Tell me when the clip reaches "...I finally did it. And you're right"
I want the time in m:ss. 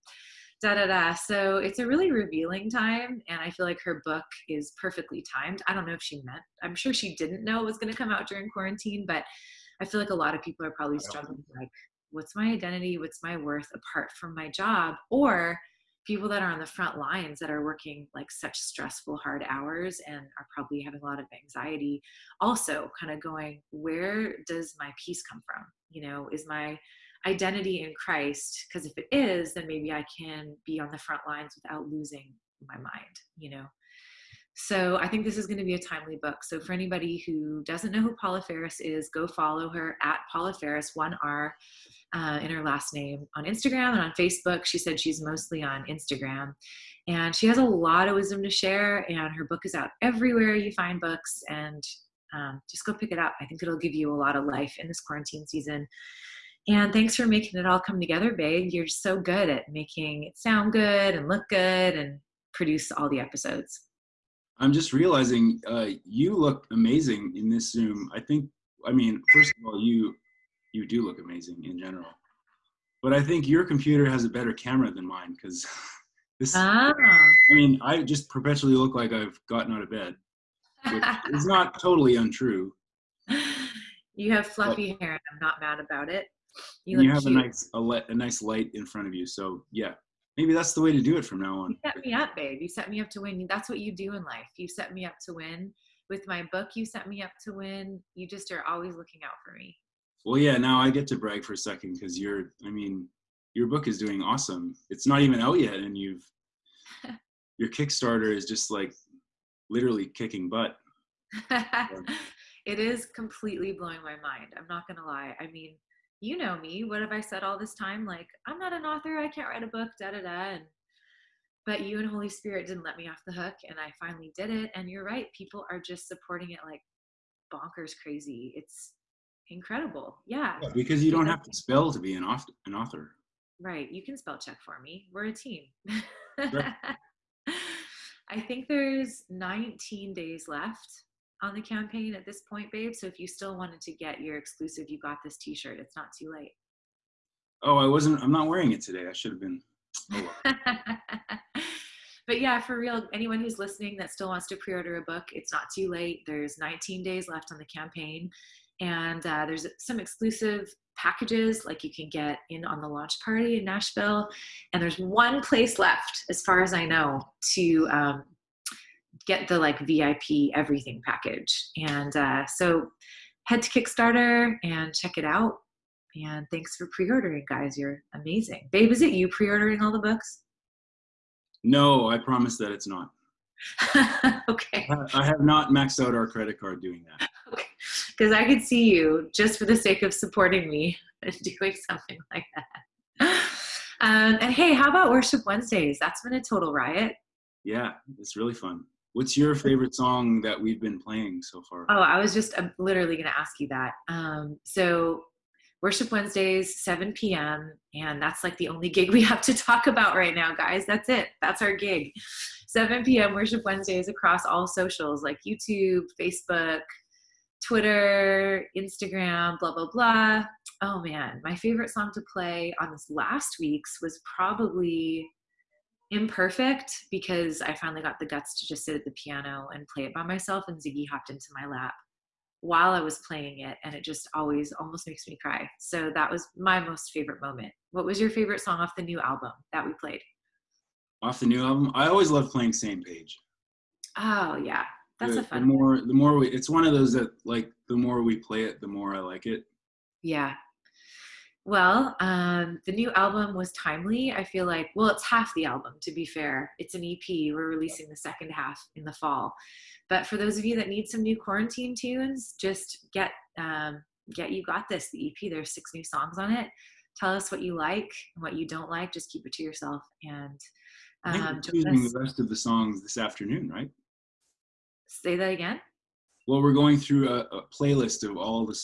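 2:03.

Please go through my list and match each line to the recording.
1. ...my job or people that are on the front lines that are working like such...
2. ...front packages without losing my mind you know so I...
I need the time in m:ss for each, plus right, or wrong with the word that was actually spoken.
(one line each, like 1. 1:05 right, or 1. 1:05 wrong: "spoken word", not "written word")
1. 0:14 right
2. 0:30 wrong: "lines", not "packages".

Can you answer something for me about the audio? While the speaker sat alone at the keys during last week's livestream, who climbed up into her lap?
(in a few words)
Ziggy.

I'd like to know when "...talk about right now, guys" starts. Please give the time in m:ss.
3:29.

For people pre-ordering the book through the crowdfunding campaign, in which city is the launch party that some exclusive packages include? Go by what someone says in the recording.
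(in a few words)
Nashville.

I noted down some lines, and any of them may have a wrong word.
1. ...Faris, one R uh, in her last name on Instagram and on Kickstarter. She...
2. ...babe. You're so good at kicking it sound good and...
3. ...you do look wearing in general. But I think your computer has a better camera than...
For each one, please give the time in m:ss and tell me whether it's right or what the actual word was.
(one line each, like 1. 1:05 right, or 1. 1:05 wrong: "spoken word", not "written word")
1. 0:40 wrong: "Facebook", not "Kickstarter"
2. 0:58 wrong: "making", not "kicking"
3. 1:10 wrong: "amazing", not "wearing".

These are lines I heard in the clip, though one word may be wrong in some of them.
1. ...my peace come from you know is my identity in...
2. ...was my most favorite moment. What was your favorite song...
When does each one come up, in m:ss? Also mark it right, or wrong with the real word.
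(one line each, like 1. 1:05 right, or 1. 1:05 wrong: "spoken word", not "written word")
1. 0:24 right
2. 3:56 right.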